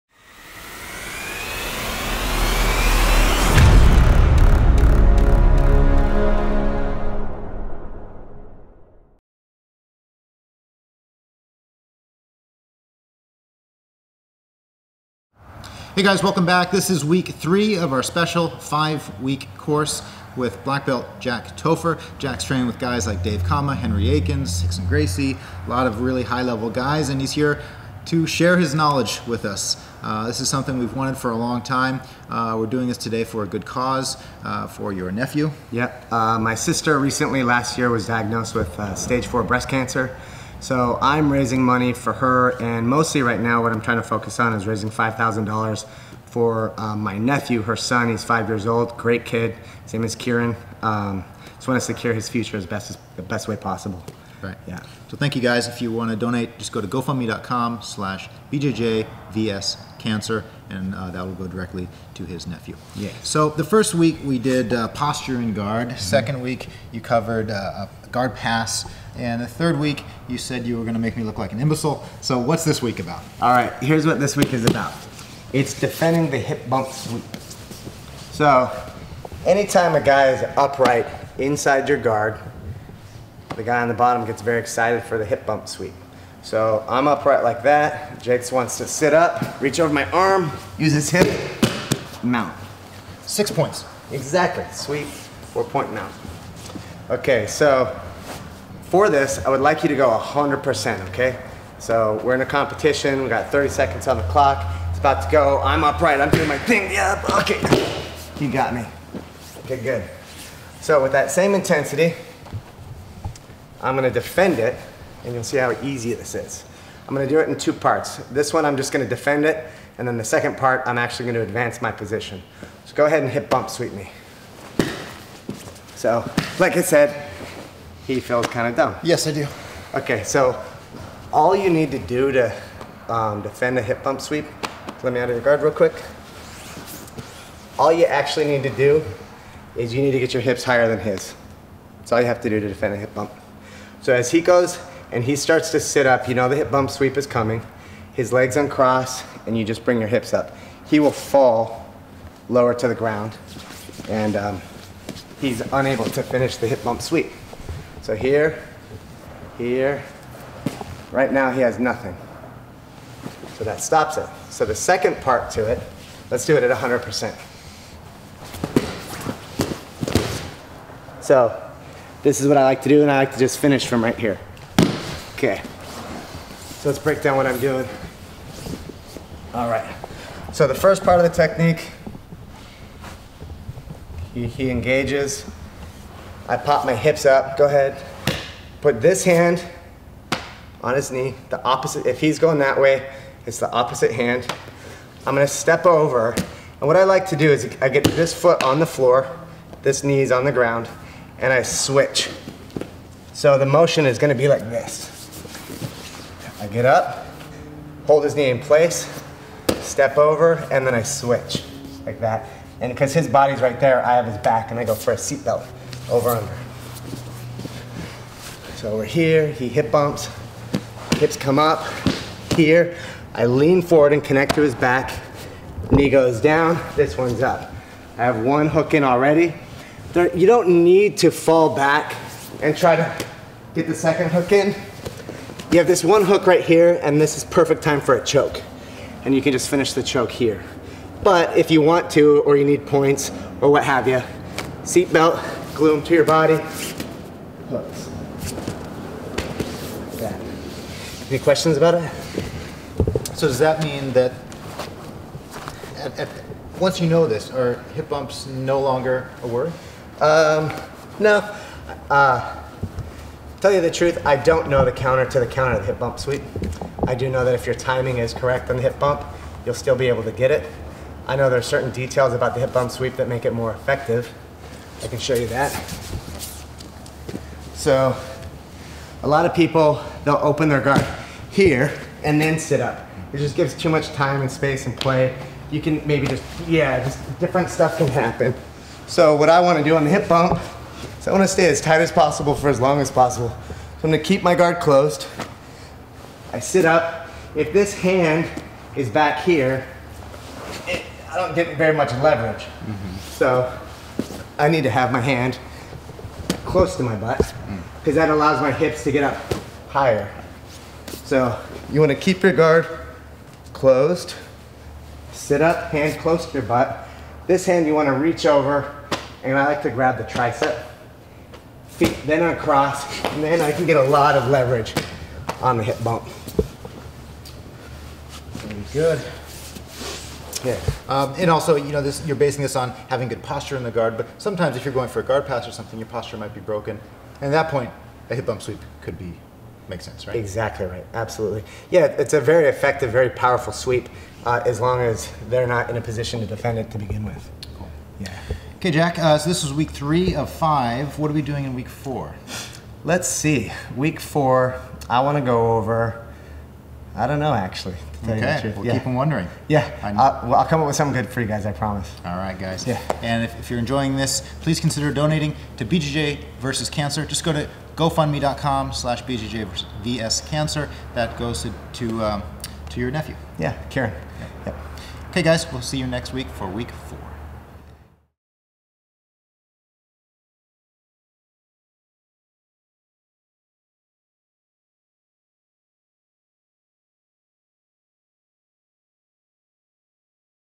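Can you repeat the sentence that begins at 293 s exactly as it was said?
So I'm going to keep my guard closed.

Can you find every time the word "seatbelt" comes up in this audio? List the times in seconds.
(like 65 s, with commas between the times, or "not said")
215 s, 244 s.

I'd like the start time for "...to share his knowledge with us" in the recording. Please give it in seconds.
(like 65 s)
28 s.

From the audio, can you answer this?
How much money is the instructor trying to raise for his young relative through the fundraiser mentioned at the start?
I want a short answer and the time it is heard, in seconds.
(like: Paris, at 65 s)
$5,000, at 44 s.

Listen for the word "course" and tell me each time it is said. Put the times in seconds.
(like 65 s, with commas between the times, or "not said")
19 s.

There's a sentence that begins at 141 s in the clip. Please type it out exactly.
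That's all you have to do to defend a hip bump.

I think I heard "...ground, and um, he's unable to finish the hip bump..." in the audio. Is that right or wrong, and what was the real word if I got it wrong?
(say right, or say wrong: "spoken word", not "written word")
right.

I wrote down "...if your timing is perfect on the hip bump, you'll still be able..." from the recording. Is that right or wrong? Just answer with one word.
wrong.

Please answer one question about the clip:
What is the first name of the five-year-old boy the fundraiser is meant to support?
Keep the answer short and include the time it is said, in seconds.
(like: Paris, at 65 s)
Kieren, at 50 s.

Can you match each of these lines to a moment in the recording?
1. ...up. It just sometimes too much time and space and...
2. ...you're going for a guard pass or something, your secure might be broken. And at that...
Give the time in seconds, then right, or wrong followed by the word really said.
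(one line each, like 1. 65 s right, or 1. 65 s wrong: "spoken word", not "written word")
1. 282 s wrong: "gives", not "sometimes"
2. 334 s wrong: "posture", not "secure".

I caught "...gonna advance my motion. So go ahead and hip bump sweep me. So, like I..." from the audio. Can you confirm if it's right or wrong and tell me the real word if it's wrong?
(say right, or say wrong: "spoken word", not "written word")
wrong: "position", not "motion".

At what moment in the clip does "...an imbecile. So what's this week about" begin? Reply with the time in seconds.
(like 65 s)
71 s.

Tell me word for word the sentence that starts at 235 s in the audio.
You have this one hook right here, and this is perfect time for a choke.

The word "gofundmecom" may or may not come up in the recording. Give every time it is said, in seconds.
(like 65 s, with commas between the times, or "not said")
56 s, 367 s.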